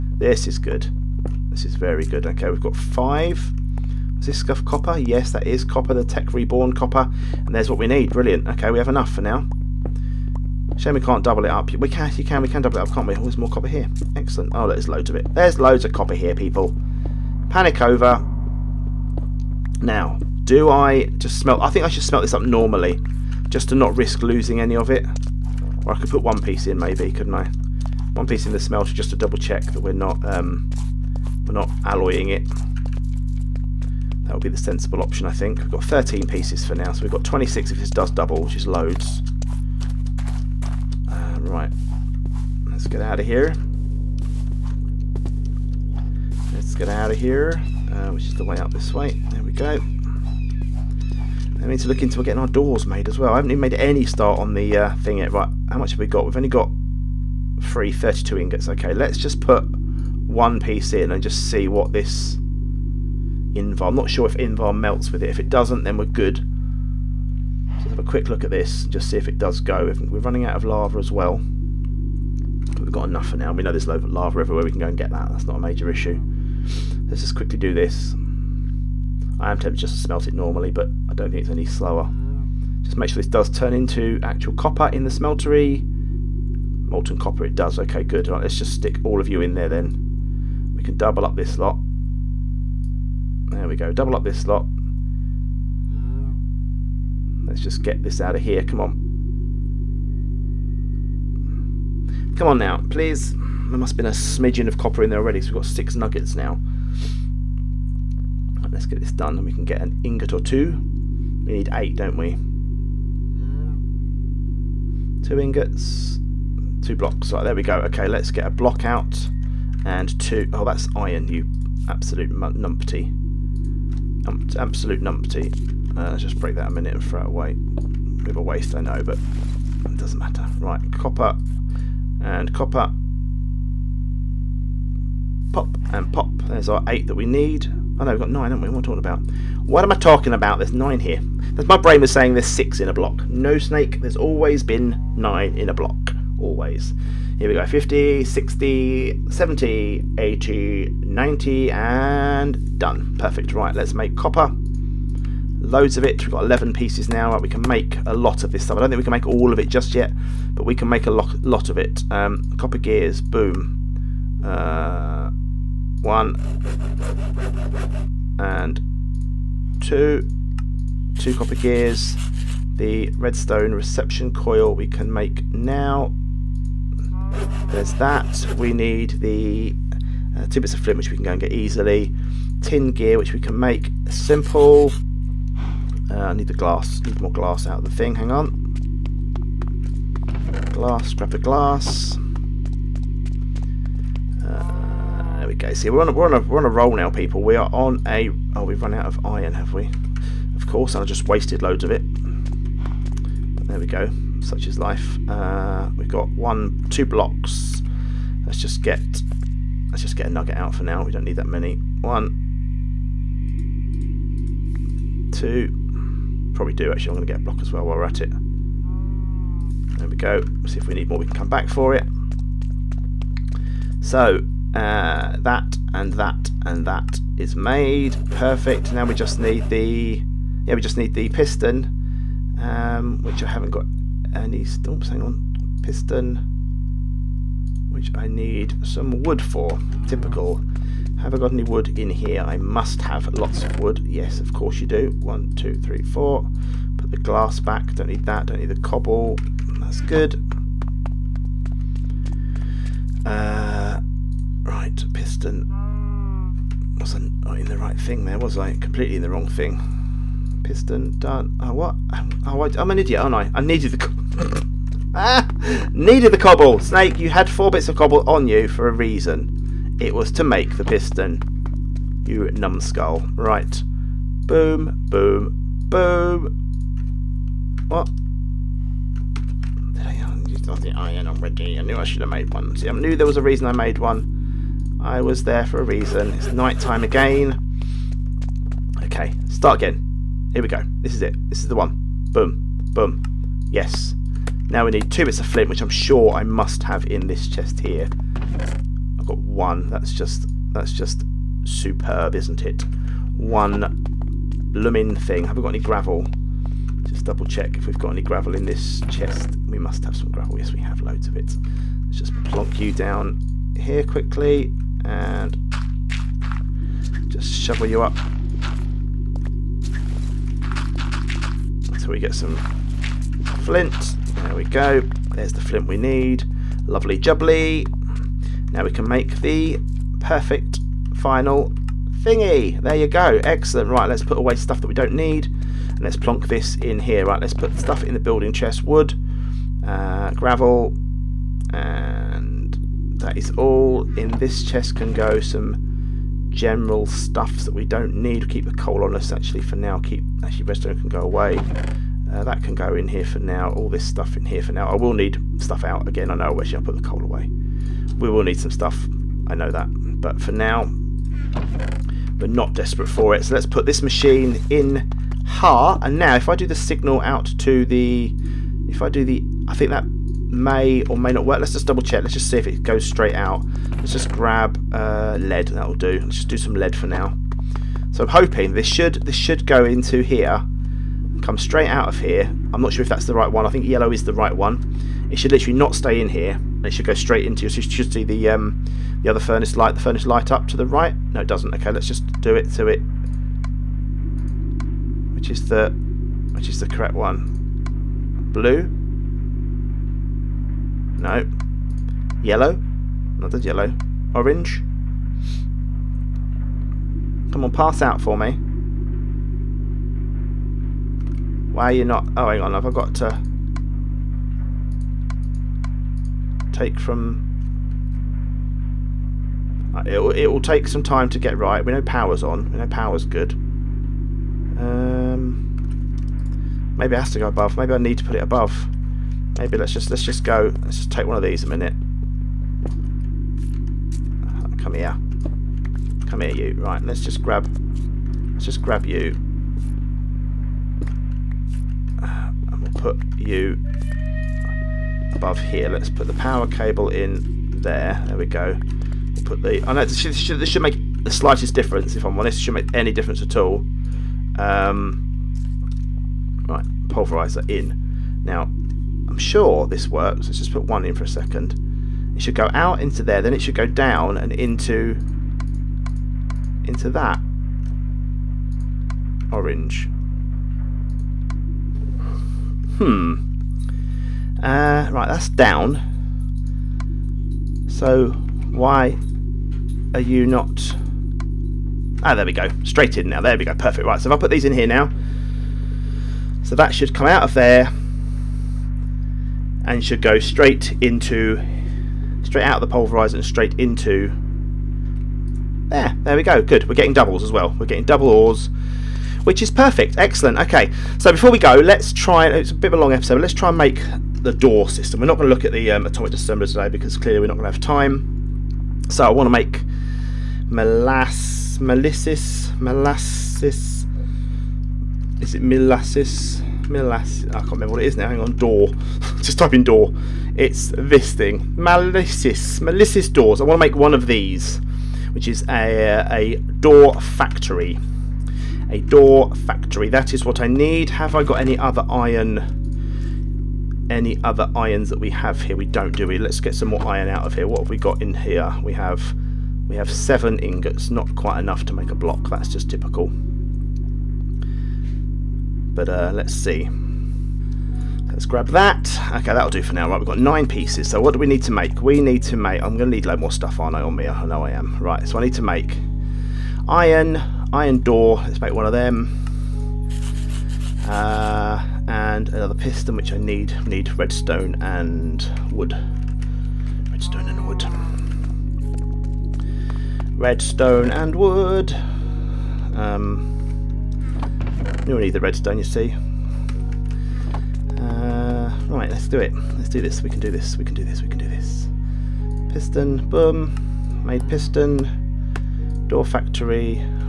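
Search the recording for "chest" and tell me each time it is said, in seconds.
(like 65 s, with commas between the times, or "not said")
297 s, 309 s, 338 s, 344 s.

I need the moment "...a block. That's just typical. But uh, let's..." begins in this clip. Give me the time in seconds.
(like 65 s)
542 s.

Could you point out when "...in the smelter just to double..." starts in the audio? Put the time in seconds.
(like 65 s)
28 s.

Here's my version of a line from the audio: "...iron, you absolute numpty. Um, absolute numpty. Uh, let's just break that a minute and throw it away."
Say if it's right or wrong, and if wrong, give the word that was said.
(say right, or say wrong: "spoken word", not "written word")
right.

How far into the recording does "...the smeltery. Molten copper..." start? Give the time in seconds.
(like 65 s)
85 s.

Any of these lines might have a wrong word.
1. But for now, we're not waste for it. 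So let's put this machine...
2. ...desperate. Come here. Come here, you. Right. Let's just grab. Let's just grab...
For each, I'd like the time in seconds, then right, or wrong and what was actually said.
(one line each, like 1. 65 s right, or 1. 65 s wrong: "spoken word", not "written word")
1. 360 s wrong: "desperate", not "waste"
2. 431 s wrong: "minute", not "desperate".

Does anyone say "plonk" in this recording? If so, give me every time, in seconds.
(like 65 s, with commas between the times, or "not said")
312 s, 336 s.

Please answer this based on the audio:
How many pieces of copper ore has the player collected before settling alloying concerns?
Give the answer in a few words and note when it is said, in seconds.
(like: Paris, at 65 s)
13, at 35 s.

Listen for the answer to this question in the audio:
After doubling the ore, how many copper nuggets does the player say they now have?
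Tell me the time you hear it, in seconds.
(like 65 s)
105 s.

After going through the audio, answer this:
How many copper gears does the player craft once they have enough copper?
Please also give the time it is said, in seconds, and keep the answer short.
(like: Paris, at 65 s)
2, at 171 s.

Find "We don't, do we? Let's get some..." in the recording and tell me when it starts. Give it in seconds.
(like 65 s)
535 s.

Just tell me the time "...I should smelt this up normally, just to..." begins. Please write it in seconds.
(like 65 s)
21 s.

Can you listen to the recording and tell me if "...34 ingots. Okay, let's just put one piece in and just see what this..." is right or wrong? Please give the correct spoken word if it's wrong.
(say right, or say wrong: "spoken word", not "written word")
wrong: "32", not "34".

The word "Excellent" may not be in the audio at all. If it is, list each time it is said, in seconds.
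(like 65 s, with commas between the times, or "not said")
14 s, 333 s, 500 s.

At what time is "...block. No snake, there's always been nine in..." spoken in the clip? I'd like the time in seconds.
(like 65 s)
142 s.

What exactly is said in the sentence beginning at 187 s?
Need more glass out of the thing.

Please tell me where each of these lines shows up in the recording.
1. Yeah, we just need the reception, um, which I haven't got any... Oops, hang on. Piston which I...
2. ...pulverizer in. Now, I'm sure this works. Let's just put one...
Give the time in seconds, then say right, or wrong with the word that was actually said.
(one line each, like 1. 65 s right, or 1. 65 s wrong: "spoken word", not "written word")
1. 230 s wrong: "piston", not "reception"
2. 457 s right.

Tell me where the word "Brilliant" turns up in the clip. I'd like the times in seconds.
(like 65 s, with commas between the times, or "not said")
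8 s.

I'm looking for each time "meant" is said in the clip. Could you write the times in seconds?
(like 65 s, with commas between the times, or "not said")
not said.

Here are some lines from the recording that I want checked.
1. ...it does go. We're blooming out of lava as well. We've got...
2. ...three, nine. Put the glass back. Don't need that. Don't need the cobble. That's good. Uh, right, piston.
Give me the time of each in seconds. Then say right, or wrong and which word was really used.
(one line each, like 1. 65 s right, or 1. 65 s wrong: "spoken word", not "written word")
1. 69 s wrong: "running", not "blooming"
2. 245 s wrong: "four", not "nine".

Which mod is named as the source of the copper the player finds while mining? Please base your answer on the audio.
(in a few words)
Tech Reborn.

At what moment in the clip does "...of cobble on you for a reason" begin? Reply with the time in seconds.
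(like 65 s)
267 s.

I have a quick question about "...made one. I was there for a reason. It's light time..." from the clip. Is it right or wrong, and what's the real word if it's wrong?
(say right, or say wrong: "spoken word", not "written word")
wrong: "night", not "light".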